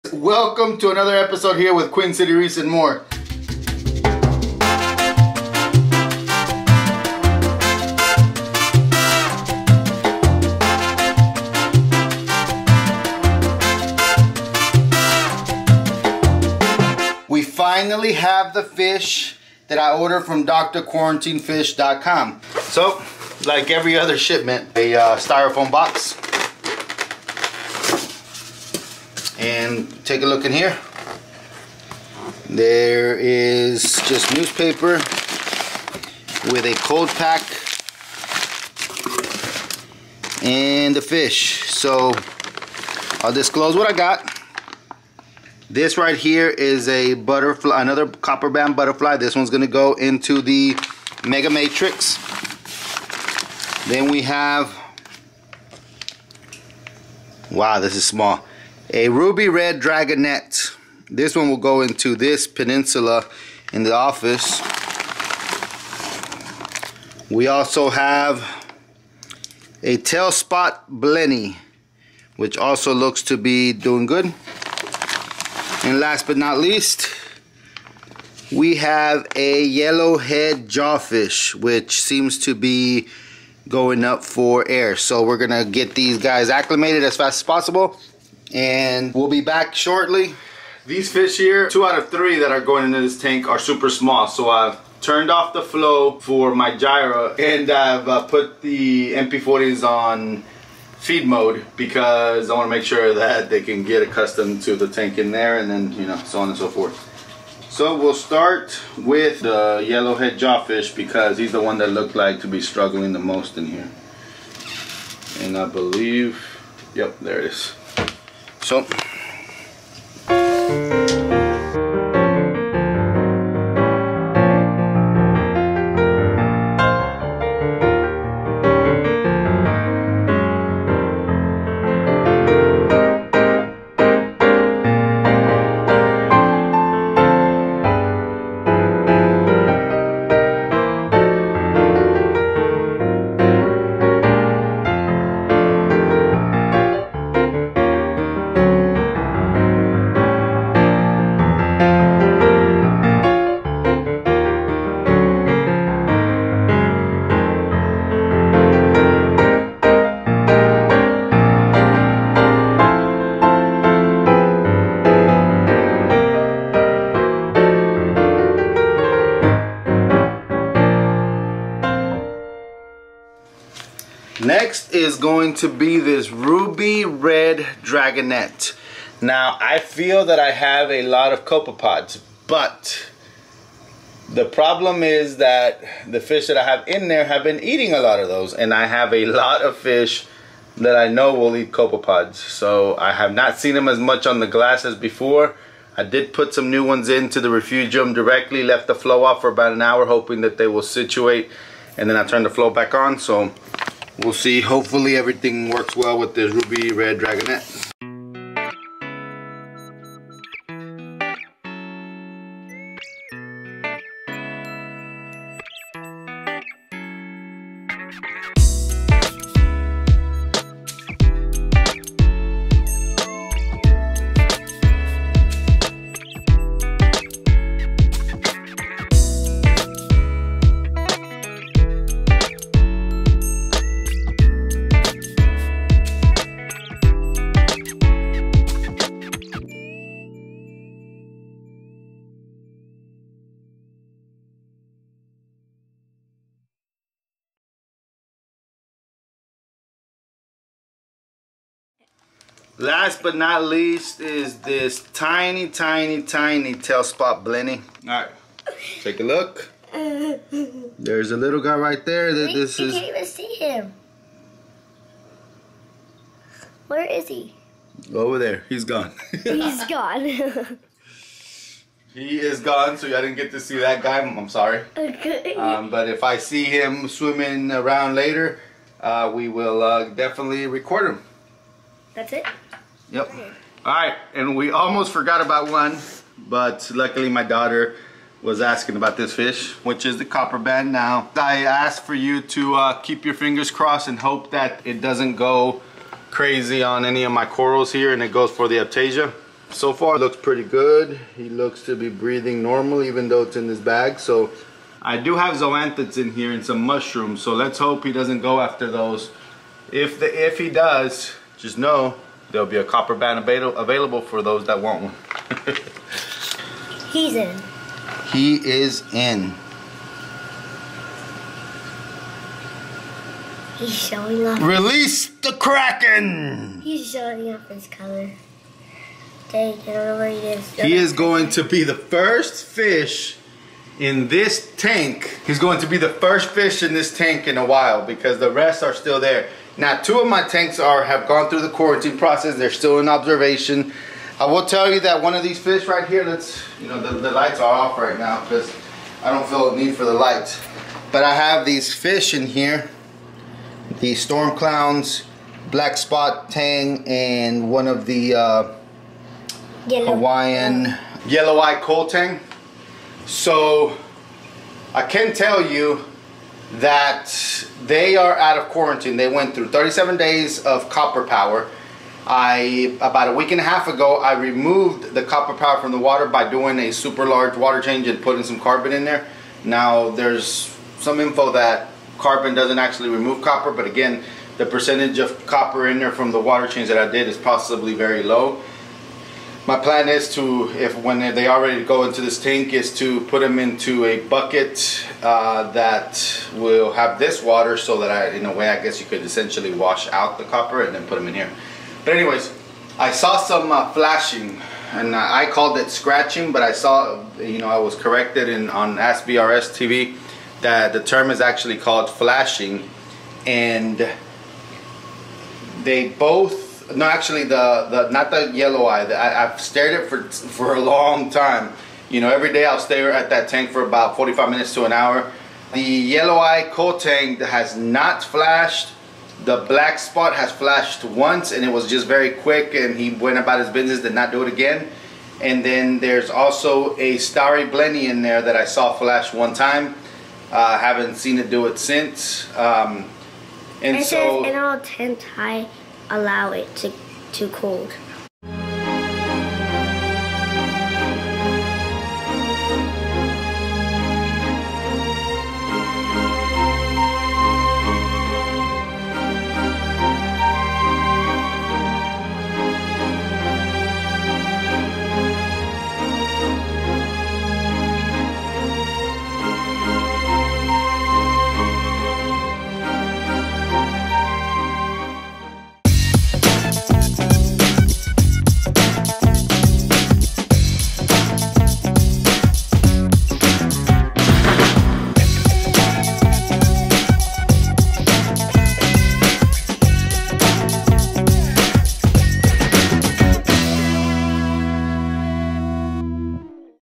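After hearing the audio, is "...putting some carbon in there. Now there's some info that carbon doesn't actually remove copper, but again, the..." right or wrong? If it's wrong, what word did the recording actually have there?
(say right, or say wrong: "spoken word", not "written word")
right.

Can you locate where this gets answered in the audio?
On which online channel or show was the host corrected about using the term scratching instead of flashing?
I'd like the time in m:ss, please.
6:48.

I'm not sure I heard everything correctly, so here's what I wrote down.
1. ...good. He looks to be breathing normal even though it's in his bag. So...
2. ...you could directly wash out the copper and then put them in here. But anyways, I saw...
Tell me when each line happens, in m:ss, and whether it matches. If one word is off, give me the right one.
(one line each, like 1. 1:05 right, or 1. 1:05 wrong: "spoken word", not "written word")
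1. 5:00 right
2. 6:38 wrong: "essentially", not "directly".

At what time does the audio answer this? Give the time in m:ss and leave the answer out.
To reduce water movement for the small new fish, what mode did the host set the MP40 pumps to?
1:40.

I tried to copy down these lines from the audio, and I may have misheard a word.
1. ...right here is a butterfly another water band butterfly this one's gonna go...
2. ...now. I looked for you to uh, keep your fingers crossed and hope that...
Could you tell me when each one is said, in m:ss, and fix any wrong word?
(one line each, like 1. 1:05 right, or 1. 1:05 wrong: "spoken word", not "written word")
1. 0:45 wrong: "copper", not "water"
2. 4:50 wrong: "asked", not "looked".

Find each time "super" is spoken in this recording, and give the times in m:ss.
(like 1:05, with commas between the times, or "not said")
1:33, 6:16.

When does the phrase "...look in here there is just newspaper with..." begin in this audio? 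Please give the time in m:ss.
0:30.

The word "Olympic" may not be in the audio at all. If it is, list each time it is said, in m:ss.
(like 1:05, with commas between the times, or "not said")
not said.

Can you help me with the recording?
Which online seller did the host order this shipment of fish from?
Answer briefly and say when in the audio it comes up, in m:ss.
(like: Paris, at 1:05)
drquarantinefish.com, at 0:20.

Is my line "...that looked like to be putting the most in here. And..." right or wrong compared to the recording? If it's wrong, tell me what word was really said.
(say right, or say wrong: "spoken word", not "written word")
wrong: "struggling", not "putting".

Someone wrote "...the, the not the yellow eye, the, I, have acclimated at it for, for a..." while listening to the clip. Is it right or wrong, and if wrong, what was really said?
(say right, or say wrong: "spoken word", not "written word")
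wrong: "stared", not "acclimated".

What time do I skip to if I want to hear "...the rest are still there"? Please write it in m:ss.
5:38.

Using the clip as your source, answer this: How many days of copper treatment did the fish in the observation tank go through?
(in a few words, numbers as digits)
37.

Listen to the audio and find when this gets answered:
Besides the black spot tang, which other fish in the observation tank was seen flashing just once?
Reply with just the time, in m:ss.
7:17.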